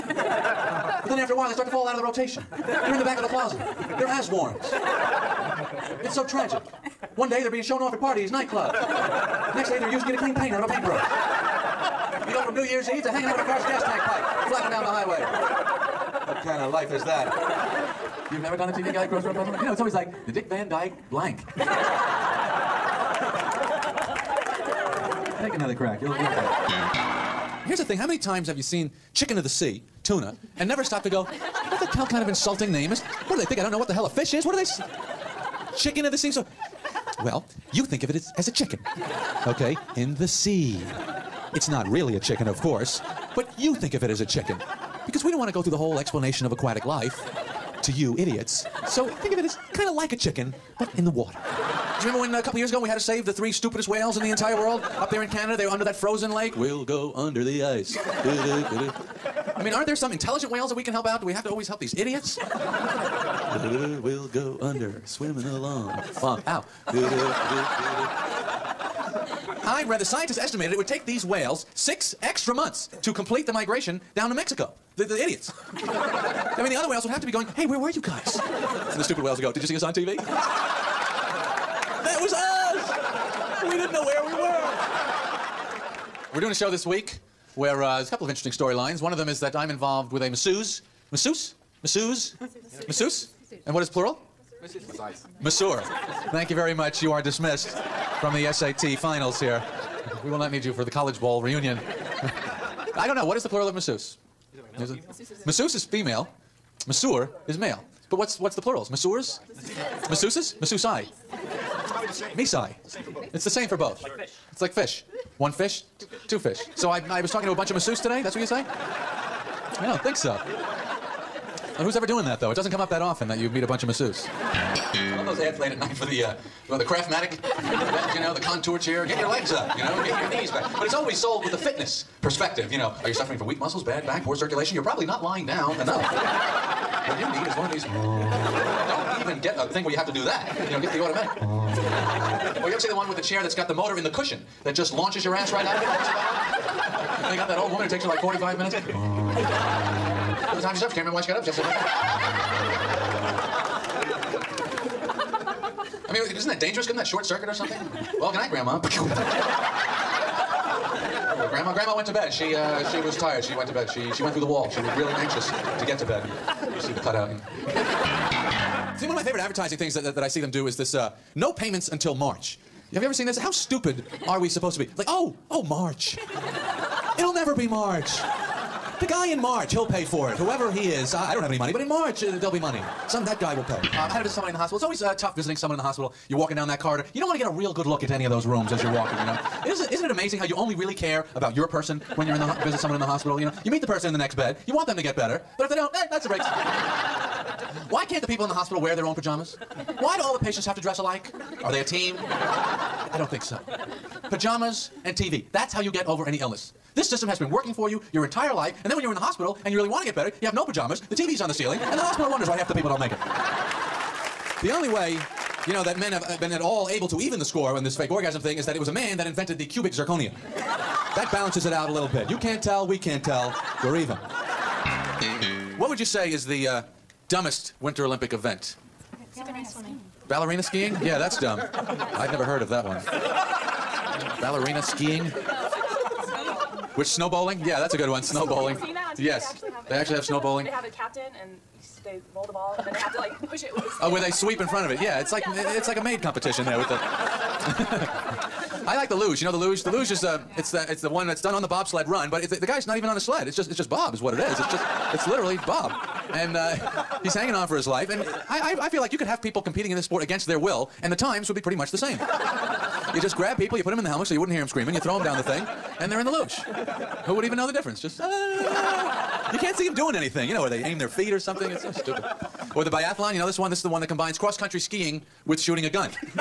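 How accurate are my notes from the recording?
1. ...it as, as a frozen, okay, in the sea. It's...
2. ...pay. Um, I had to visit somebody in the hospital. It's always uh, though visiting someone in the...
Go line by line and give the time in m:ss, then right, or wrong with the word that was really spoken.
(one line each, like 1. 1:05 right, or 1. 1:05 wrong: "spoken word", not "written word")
1. 0:38 wrong: "chicken", not "frozen"
2. 3:03 wrong: "tough", not "though".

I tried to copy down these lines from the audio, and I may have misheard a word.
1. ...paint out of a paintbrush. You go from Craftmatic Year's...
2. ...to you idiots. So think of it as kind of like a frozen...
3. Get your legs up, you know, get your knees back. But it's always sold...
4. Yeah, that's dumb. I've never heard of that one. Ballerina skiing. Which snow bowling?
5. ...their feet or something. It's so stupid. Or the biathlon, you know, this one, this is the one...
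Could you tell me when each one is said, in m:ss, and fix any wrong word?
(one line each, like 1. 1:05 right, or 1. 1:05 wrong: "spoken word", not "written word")
1. 0:10 wrong: "New", not "Craftmatic"
2. 0:47 wrong: "chicken", not "frozen"
3. 2:09 right
4. 3:51 right
5. 4:30 right.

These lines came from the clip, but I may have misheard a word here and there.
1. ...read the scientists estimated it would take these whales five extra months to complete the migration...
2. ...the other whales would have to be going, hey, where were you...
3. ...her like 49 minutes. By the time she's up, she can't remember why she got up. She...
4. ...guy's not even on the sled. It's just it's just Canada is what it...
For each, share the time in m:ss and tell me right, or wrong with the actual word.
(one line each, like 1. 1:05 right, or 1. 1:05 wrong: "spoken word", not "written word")
1. 1:09 wrong: "six", not "five"
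2. 1:16 right
3. 2:28 wrong: "45", not "49"
4. 4:12 wrong: "Bob", not "Canada".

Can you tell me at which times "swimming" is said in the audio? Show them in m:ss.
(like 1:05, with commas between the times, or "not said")
1:05, 3:49.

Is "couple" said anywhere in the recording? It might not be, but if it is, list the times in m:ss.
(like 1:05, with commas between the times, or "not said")
0:52, 1:28.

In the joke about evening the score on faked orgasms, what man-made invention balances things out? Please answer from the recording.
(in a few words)
Cubic zirconia.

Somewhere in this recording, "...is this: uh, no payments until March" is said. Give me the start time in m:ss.
2:50.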